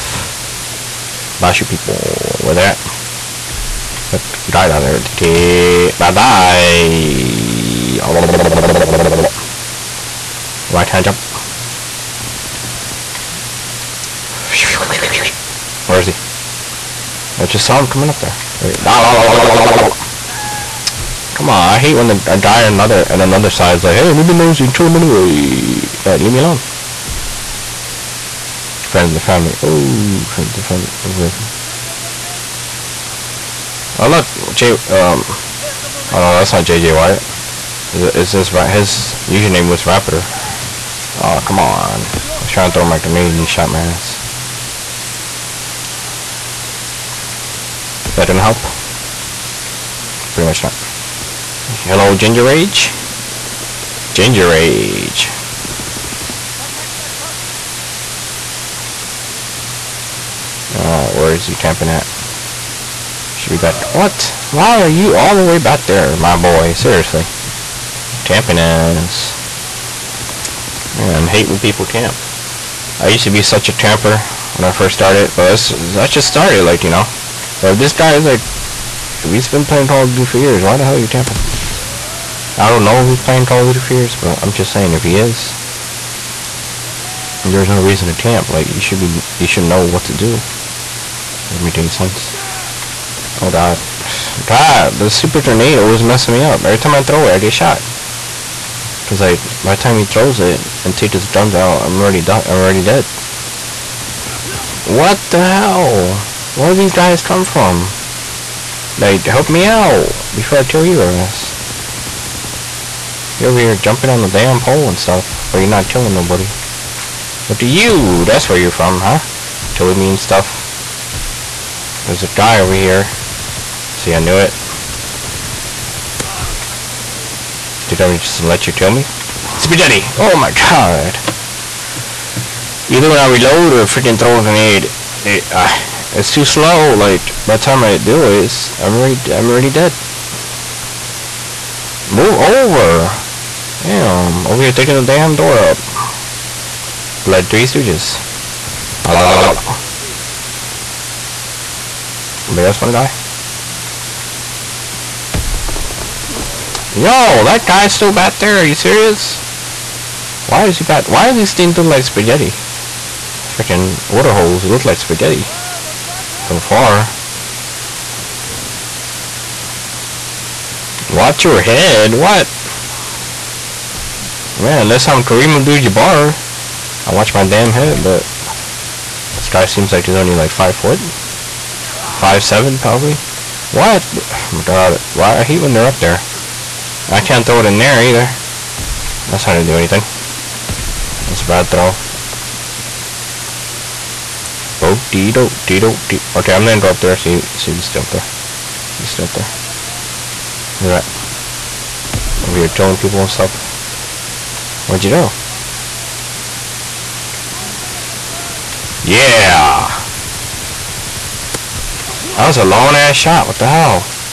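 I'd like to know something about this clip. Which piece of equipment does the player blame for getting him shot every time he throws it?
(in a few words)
super tornado.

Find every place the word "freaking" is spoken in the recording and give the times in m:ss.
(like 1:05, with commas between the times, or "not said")
2:13, 2:43.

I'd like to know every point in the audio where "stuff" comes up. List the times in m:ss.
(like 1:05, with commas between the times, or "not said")
1:54, 2:00, 3:23.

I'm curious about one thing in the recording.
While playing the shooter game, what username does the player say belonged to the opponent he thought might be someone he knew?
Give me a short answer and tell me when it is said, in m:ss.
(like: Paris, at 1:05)
Raptor, at 0:39.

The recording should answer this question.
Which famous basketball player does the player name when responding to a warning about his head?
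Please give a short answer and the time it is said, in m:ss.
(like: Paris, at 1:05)
Kareem Abdul-Jabbar, at 2:55.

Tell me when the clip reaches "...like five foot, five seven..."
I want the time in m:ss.
3:00.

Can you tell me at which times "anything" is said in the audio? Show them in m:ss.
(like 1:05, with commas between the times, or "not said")
3:09.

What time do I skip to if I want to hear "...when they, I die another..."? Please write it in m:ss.
0:21.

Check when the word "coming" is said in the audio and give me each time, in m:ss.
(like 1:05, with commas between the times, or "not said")
0:17.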